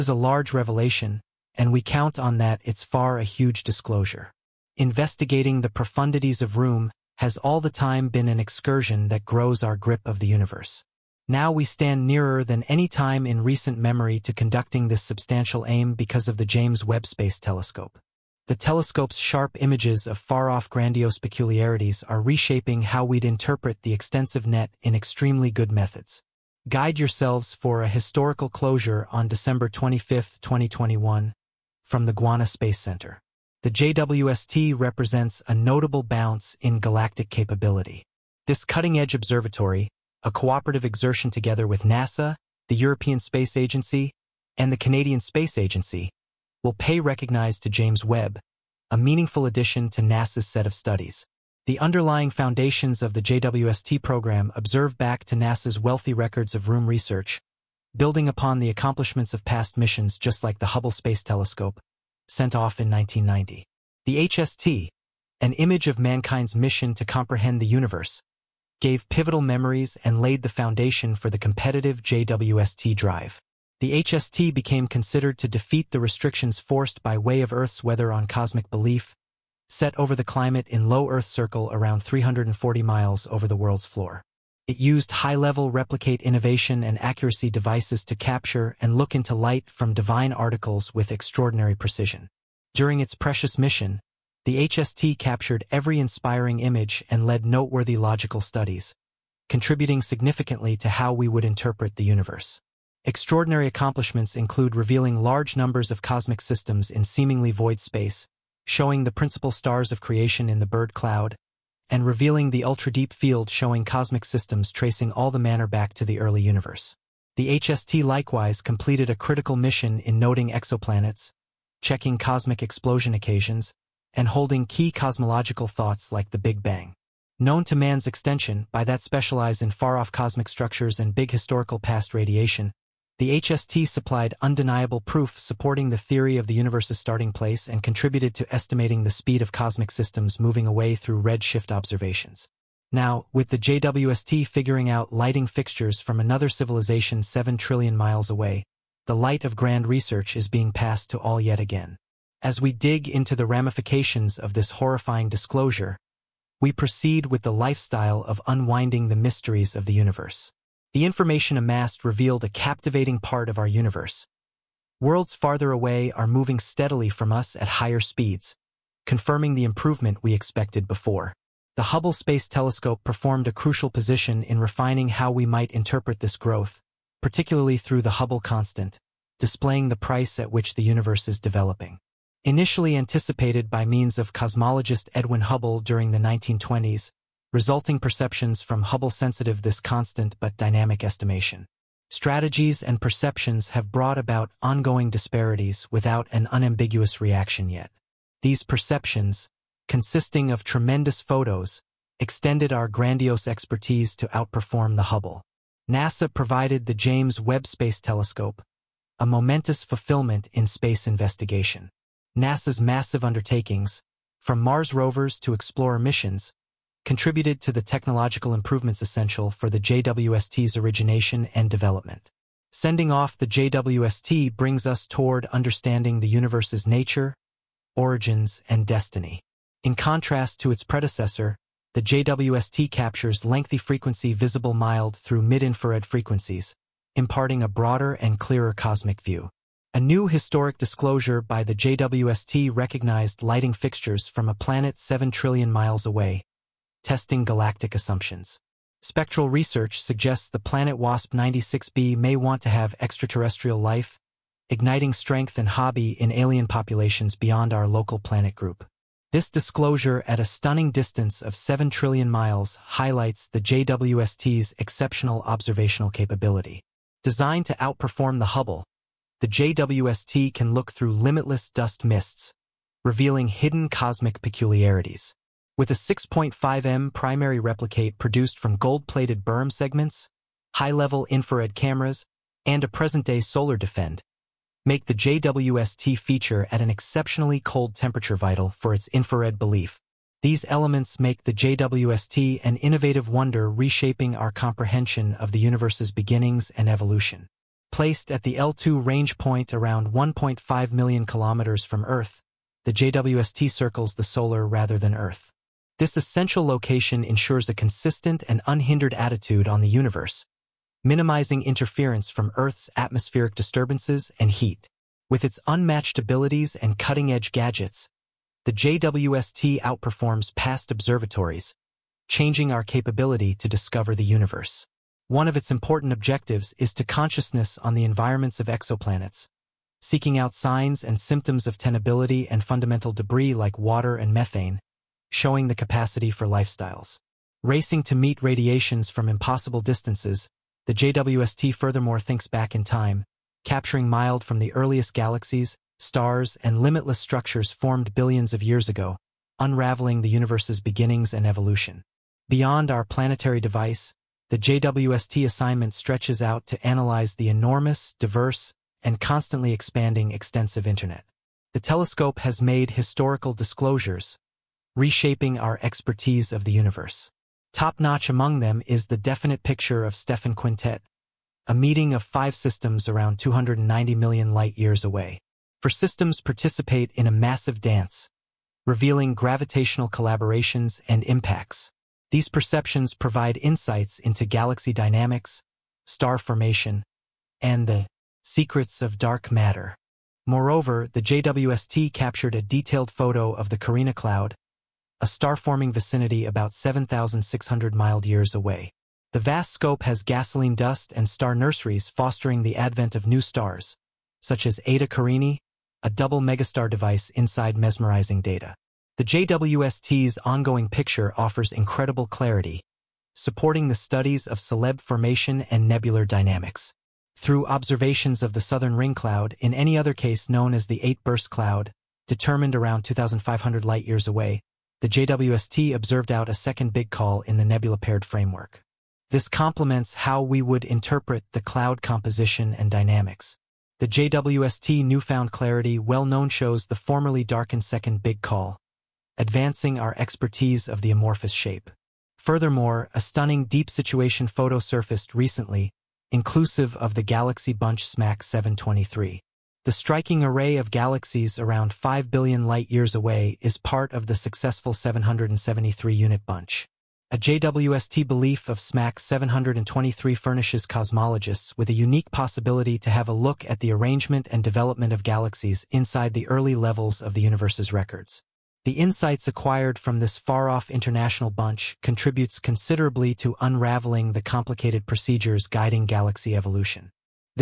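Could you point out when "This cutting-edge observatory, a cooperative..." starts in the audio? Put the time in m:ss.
0:38.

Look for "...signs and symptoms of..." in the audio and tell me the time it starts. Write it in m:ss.
5:30.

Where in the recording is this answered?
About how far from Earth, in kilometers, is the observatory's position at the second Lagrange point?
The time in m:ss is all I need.
5:00.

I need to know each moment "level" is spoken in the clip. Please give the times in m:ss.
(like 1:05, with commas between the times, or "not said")
1:25, 4:40, 7:46.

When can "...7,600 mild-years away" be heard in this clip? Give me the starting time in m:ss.
6:36.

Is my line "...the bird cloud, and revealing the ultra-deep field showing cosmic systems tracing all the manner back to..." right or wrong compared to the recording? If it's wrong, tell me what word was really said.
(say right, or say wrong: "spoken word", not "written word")
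right.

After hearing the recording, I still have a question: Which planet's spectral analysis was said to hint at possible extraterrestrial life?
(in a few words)
WASP-96b.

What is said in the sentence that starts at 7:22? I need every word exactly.
Furthermore, a stunning deep situation photo surfaced recently, inclusive of the Galaxy Bunch SMAC 723.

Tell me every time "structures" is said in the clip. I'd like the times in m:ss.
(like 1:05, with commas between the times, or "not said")
2:10, 5:47.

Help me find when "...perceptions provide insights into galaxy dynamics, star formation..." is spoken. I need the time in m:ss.
6:22.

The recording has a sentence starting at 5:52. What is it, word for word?
Beyond our planetary device, the JWST assignment stretches out to analyze the enormous, diverse, and constantly expanding extensive Internet.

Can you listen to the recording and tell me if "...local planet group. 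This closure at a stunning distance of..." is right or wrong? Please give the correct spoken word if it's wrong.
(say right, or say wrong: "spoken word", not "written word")
wrong: "disclosure", not "closure".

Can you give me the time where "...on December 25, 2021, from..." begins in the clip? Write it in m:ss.
0:29.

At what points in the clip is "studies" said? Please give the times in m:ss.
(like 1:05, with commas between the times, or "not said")
0:50, 1:38, 6:53.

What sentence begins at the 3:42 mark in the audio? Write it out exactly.
Sending off the JWST brings us toward understanding the universe's nature, origins, and destiny.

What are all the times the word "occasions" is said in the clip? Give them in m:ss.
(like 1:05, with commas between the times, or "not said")
2:03.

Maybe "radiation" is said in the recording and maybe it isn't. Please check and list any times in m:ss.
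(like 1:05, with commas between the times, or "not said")
2:12, 5:38.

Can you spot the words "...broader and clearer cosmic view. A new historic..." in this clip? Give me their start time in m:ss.
3:57.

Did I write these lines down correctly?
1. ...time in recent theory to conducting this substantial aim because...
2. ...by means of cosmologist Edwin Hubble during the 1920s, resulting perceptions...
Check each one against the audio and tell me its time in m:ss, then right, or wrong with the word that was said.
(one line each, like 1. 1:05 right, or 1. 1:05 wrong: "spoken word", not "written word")
1. 0:12 wrong: "memory", not "theory"
2. 3:03 right.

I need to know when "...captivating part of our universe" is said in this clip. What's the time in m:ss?
2:42.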